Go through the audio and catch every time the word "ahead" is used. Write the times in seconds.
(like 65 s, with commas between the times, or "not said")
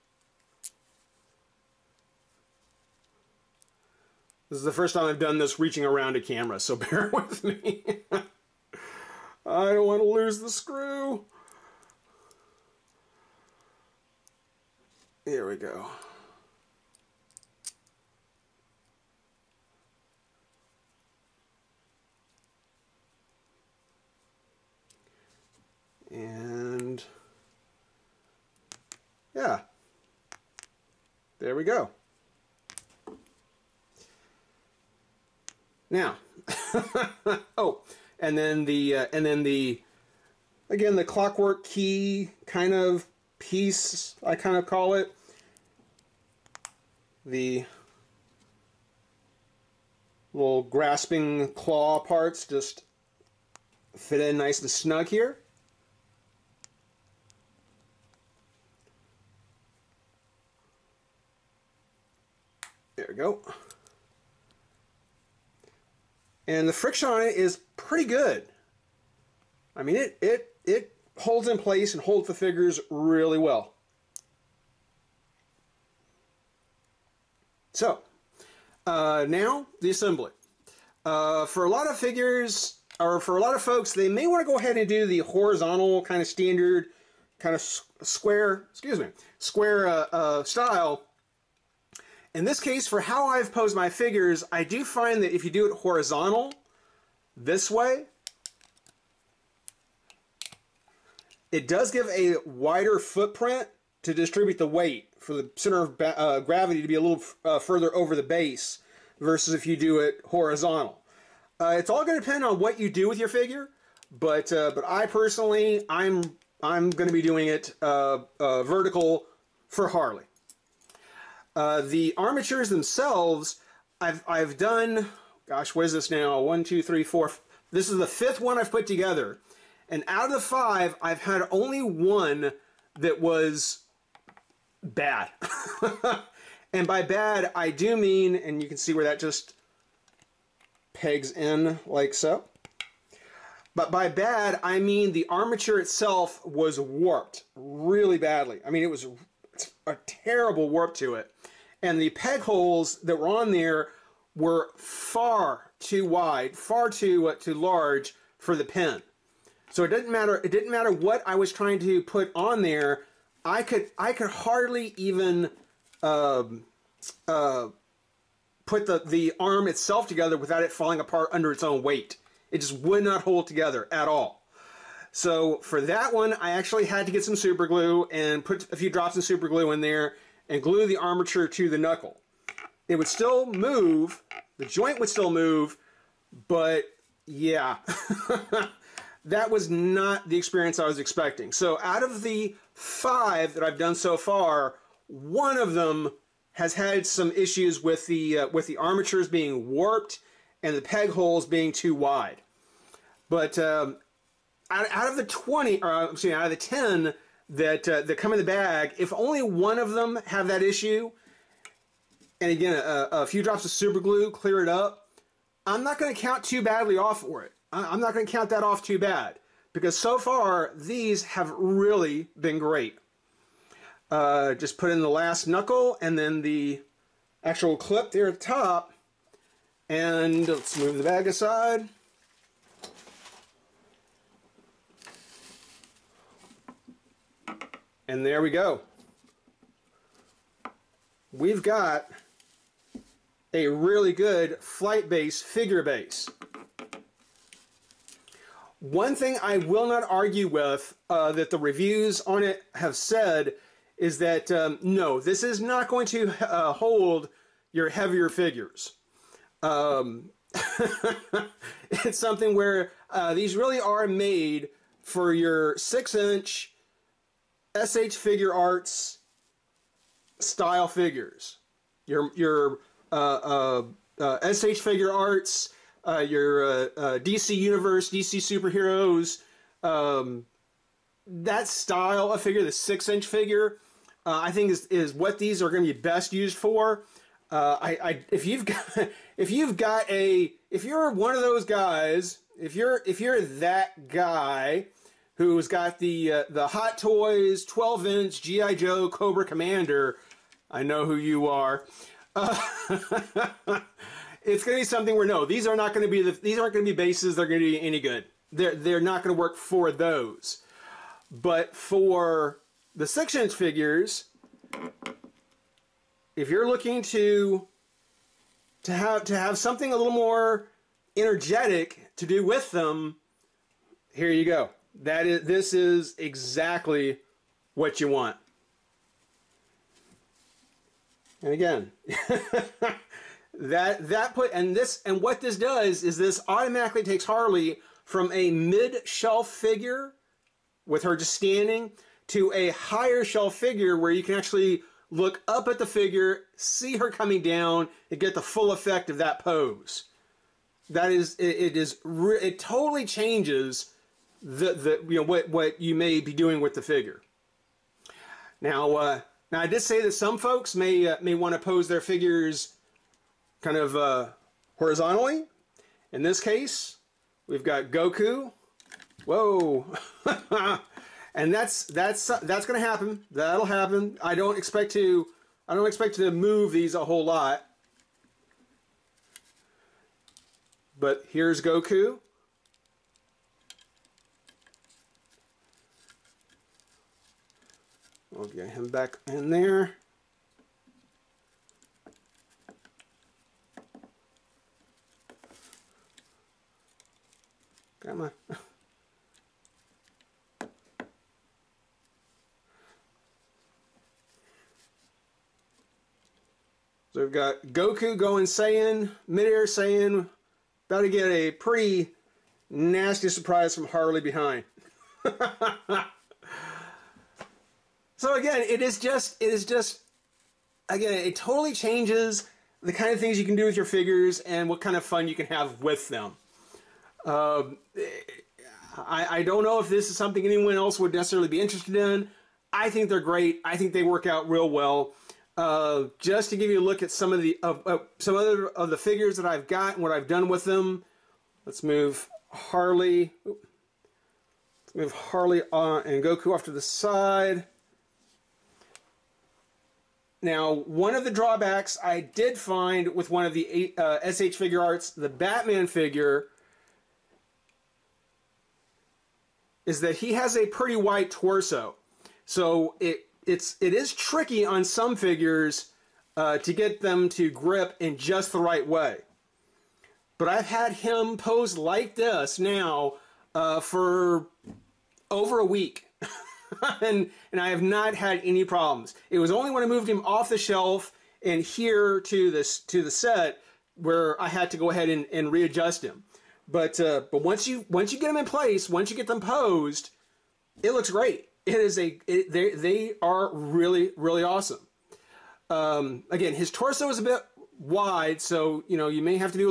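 84 s, 484 s.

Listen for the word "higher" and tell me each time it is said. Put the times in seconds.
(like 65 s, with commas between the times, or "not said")
342 s.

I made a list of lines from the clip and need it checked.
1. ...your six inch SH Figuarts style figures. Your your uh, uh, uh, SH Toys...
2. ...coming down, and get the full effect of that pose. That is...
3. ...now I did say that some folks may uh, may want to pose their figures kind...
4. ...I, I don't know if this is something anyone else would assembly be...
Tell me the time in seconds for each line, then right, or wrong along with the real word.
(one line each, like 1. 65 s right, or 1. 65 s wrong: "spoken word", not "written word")
1. 265 s wrong: "Figuarts", not "Toys"
2. 347 s right
3. 359 s right
4. 428 s wrong: "necessarily", not "assembly".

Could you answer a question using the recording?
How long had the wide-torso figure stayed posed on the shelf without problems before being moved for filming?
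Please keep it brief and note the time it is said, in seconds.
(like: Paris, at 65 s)
over a week, at 475 s.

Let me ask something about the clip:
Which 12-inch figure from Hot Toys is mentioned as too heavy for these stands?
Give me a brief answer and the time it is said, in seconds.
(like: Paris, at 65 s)
Cobra Commander, at 299 s.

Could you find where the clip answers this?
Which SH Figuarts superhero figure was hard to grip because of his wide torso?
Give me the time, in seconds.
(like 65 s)
455 s.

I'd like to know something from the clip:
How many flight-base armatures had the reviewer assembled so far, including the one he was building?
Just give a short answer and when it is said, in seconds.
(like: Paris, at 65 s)
5, at 128 s.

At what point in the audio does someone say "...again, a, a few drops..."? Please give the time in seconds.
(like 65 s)
212 s.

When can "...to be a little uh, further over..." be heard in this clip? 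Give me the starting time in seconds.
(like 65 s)
106 s.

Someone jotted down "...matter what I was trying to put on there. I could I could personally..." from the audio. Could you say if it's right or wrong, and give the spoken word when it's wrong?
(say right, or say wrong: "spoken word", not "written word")
wrong: "hardly", not "personally".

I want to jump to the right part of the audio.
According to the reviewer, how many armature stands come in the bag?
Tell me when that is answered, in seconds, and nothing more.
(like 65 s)
206 s.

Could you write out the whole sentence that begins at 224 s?
Uh, just put in the last knuckle and then the actual clip there at the top.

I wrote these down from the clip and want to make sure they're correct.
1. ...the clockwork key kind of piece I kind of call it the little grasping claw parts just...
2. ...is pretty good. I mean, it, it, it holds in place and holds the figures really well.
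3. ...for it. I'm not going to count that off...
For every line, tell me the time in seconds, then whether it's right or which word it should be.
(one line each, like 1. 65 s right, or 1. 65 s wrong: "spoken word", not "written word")
1. 40 s right
2. 67 s right
3. 217 s right.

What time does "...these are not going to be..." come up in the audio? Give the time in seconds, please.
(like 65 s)
305 s.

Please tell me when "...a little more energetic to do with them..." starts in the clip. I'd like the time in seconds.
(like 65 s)
319 s.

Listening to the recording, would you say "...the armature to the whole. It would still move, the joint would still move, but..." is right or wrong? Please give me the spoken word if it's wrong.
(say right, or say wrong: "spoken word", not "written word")
wrong: "knuckle", not "whole".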